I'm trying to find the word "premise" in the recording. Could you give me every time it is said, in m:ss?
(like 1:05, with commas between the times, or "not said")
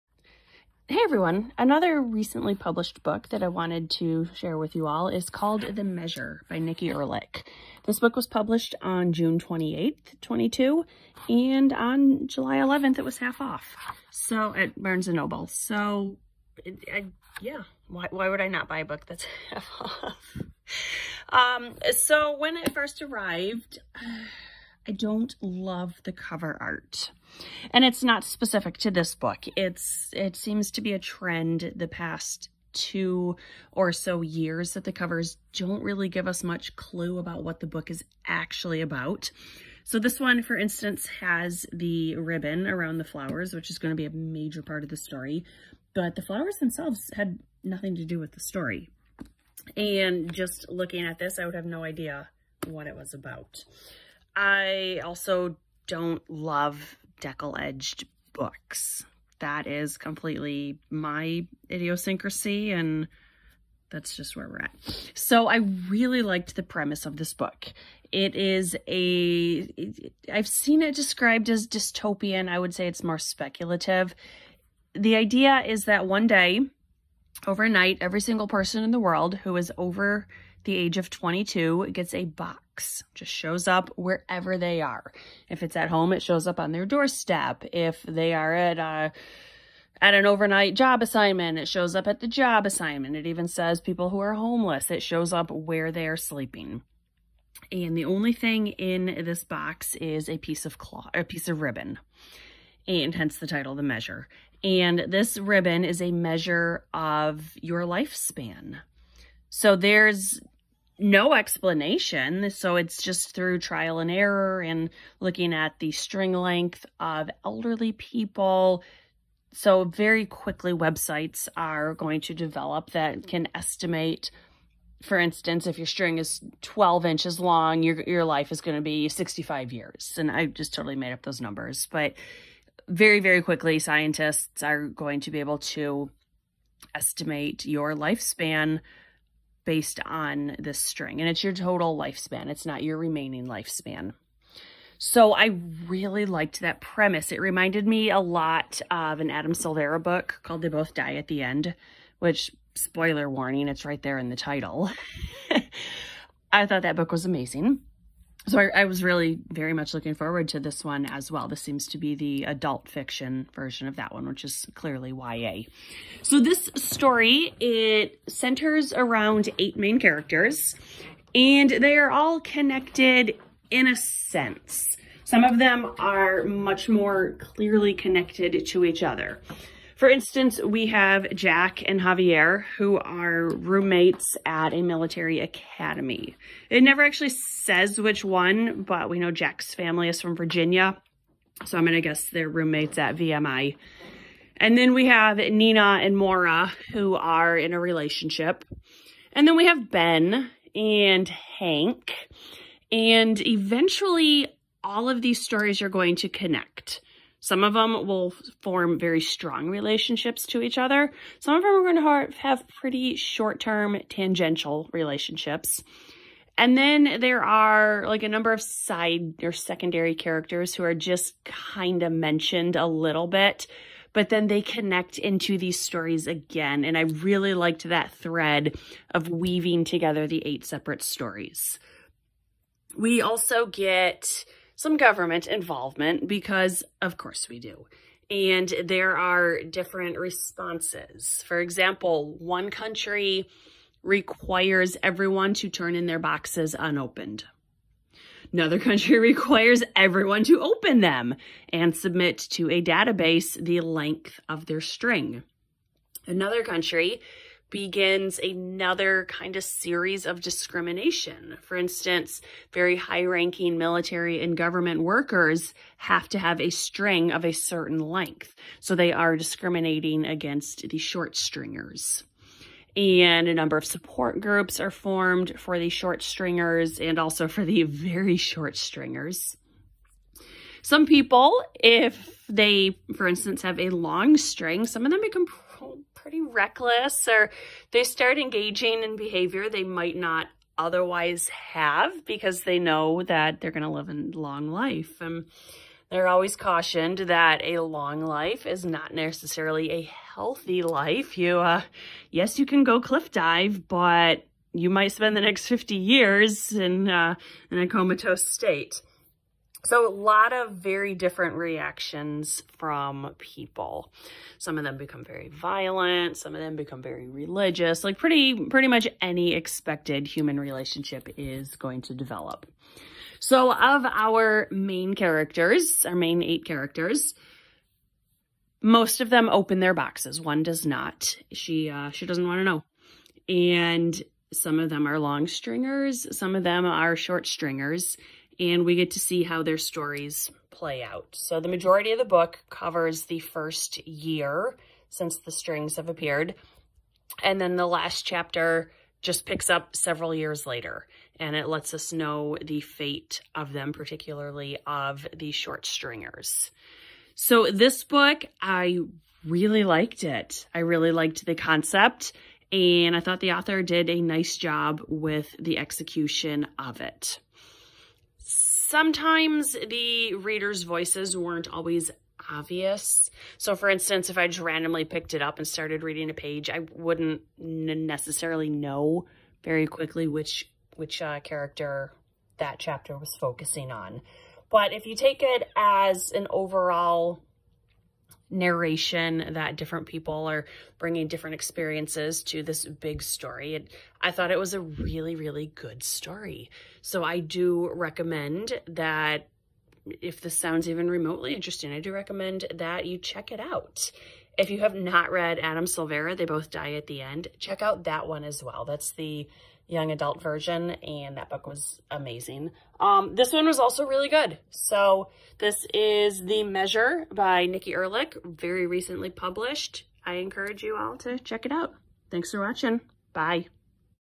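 1:06, 2:26.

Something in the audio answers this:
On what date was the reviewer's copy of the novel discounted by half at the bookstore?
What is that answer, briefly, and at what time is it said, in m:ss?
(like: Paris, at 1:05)
July 11th, at 0:12.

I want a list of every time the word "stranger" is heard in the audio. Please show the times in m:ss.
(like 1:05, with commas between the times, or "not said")
not said.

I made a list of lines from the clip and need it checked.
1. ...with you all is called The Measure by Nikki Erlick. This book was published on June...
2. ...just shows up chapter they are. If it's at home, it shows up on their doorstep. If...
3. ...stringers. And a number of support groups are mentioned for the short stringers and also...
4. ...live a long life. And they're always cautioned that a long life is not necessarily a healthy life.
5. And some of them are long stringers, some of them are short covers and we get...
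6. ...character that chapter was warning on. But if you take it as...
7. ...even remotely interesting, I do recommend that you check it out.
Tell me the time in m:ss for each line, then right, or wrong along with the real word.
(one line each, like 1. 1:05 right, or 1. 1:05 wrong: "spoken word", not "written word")
1. 0:04 right
2. 1:23 wrong: "wherever", not "chapter"
3. 4:31 wrong: "formed", not "mentioned"
4. 4:53 right
5. 5:33 wrong: "stringers", not "covers"
6. 6:21 wrong: "focusing", not "warning"
7. 6:40 right.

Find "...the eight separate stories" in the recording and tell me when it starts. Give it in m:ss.
3:50.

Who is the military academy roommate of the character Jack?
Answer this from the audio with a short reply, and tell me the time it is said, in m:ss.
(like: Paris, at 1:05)
Javier, at 3:02.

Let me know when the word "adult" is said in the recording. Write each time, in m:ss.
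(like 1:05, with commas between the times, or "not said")
2:42, 6:50.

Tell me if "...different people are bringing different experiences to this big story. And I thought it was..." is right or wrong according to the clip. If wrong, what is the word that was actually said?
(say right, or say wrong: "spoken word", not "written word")
right.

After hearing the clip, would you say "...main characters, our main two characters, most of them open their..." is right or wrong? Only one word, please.
wrong.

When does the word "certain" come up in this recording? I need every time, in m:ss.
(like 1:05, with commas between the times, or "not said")
4:27.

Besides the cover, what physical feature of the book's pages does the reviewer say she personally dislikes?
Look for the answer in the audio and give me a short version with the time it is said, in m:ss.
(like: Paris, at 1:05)
Deckle edged, at 0:57.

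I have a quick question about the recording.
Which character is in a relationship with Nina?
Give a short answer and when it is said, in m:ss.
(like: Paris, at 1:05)
Maura, at 3:16.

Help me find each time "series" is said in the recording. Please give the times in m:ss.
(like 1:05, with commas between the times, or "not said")
4:19.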